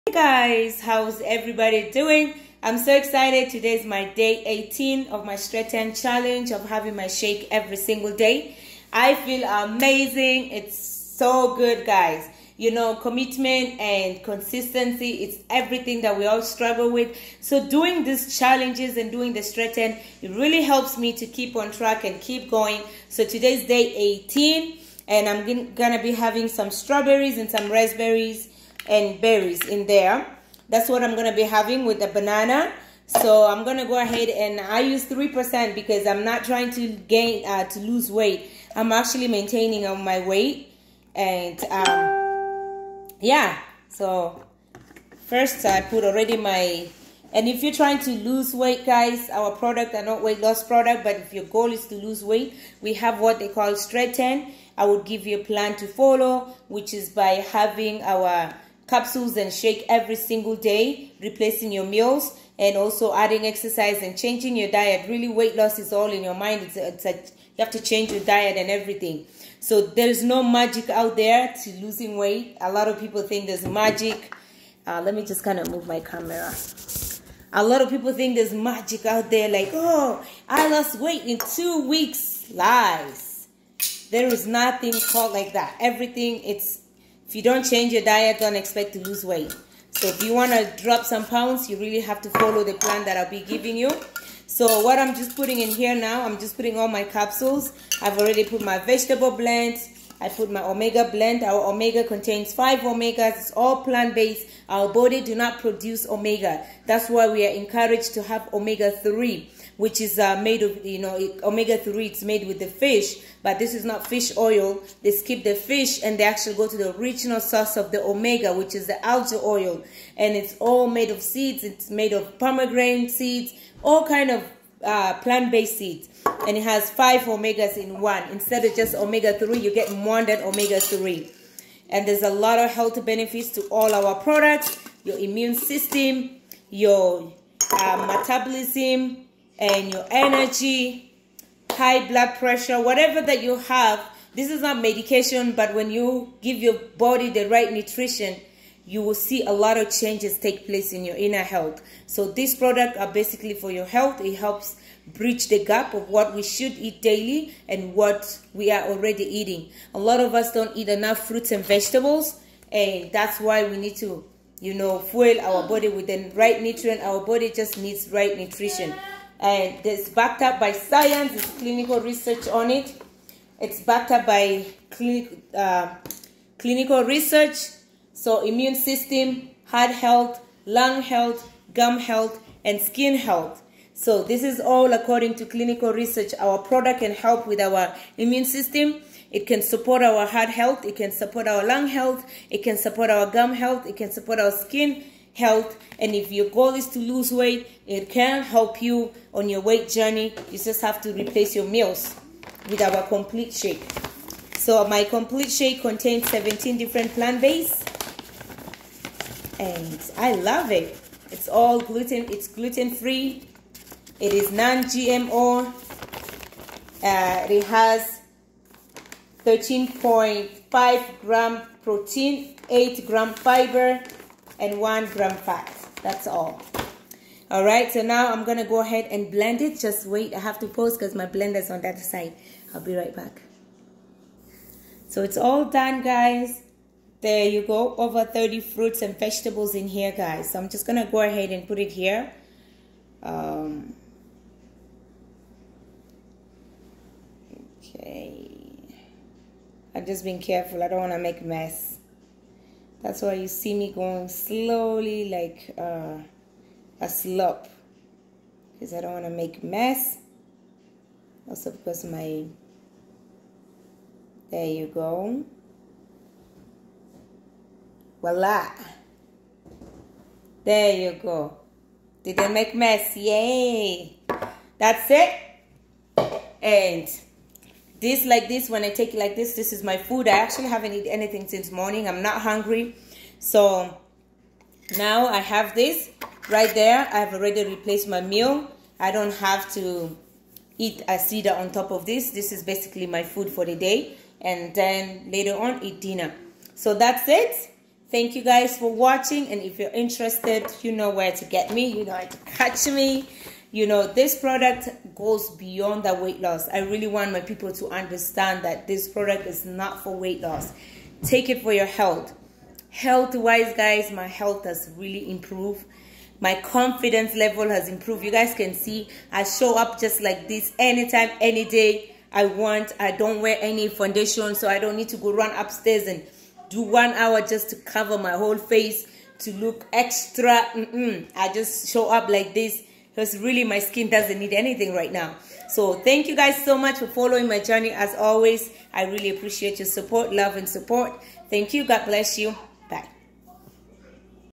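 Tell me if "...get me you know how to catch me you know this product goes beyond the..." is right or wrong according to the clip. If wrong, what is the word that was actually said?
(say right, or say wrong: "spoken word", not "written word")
right.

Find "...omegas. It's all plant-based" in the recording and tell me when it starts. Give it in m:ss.
1:42.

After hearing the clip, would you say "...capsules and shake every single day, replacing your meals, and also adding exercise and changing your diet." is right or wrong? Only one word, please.
right.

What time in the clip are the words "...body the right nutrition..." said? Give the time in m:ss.
2:26.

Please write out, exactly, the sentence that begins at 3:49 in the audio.
Just wait, I have to pause because my blender's on that side.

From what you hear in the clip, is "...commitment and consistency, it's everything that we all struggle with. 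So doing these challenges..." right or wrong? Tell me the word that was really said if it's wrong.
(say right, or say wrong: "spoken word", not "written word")
right.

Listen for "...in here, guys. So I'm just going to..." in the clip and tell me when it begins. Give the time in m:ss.
3:59.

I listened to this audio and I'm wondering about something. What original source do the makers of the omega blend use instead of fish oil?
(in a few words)
Algae oil.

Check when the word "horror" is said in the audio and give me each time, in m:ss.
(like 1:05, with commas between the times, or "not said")
not said.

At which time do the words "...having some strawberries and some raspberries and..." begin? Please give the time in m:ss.
0:26.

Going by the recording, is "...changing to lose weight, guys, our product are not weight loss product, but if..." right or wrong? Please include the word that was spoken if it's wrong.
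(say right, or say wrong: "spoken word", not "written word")
wrong: "trying", not "changing".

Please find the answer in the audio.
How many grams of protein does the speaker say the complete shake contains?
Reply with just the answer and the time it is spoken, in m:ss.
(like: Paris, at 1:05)
13.5 grams, at 3:39.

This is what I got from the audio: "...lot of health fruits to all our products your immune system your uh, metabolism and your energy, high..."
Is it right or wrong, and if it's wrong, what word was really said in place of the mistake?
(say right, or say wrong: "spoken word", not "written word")
wrong: "benefits", not "fruits".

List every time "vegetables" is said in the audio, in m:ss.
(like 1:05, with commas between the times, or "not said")
1:38, 2:41, 3:59.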